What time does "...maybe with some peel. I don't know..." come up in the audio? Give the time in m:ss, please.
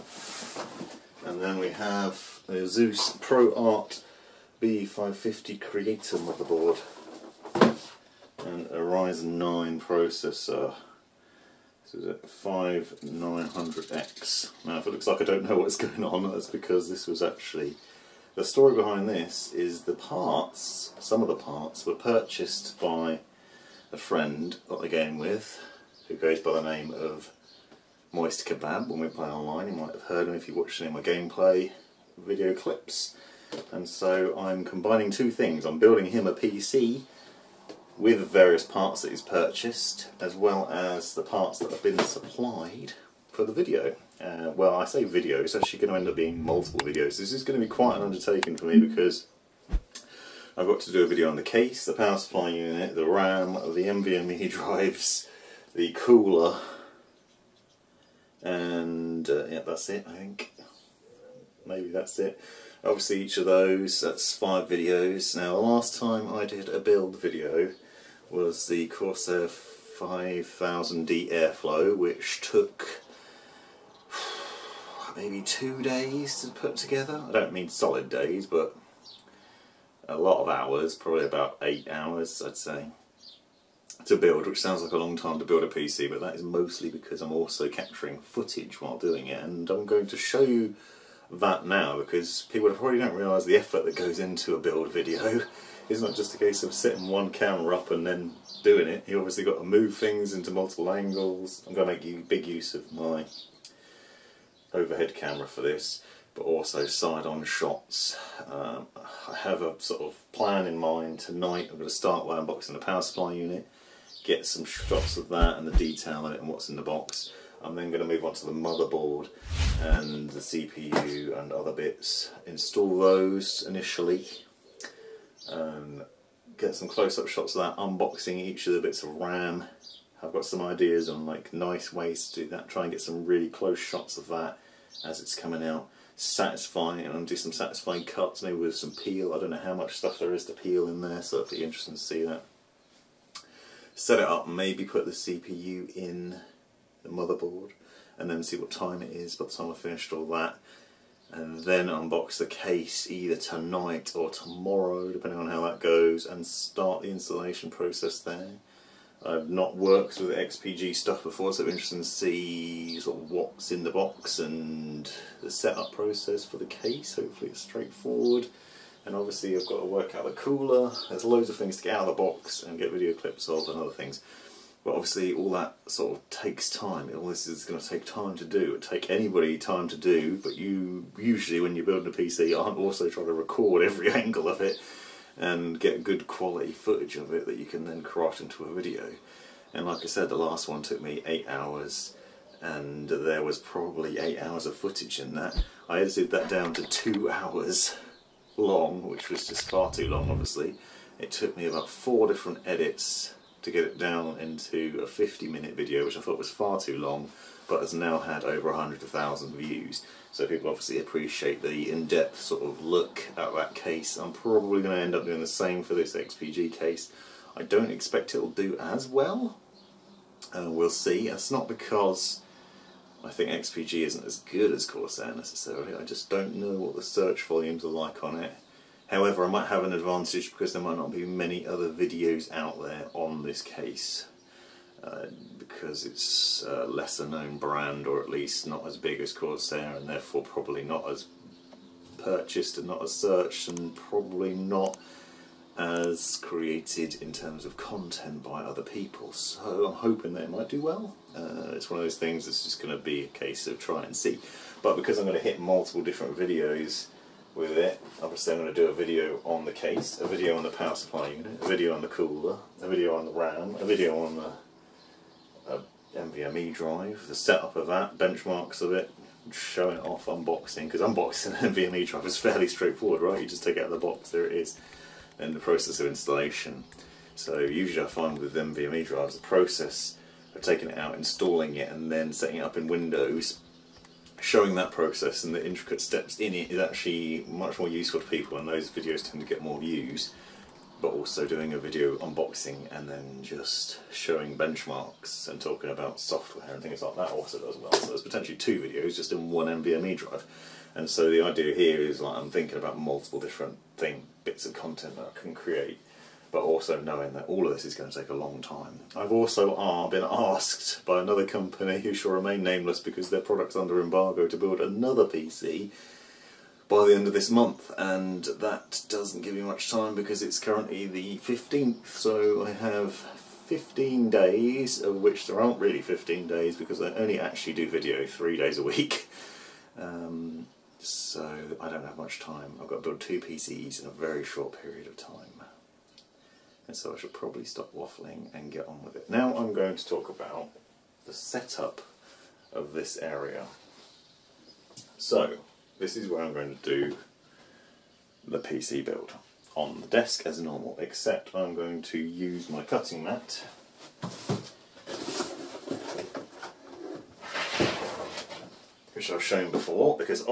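2:18.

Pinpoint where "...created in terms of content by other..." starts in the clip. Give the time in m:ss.
4:06.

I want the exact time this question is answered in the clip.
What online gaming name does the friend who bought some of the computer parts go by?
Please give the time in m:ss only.
0:28.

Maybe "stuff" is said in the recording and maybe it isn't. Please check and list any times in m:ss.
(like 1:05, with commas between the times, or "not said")
2:19, 2:40.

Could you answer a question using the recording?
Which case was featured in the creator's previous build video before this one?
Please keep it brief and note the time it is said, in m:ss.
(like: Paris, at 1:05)
Corsair 5000D Airflow, at 1:08.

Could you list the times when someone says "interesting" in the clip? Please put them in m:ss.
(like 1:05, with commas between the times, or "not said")
2:21, 2:41.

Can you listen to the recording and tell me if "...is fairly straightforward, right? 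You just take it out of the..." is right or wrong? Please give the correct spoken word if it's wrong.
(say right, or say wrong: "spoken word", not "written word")
right.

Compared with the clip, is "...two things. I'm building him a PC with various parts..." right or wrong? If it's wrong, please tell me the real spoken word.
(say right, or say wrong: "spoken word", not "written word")
right.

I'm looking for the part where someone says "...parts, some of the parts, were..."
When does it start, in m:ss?
0:19.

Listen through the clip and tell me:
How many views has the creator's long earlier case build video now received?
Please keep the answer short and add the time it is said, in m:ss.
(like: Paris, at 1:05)
over 100,000, at 3:28.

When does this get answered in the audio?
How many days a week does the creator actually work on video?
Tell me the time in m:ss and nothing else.
5:28.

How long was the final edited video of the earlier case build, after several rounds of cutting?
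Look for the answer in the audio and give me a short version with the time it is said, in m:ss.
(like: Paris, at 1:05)
50 minutes, at 3:25.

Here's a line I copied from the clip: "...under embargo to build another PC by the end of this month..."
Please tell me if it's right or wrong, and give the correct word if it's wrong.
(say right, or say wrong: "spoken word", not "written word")
right.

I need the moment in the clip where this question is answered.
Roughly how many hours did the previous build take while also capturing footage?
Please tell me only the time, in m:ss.
1:21.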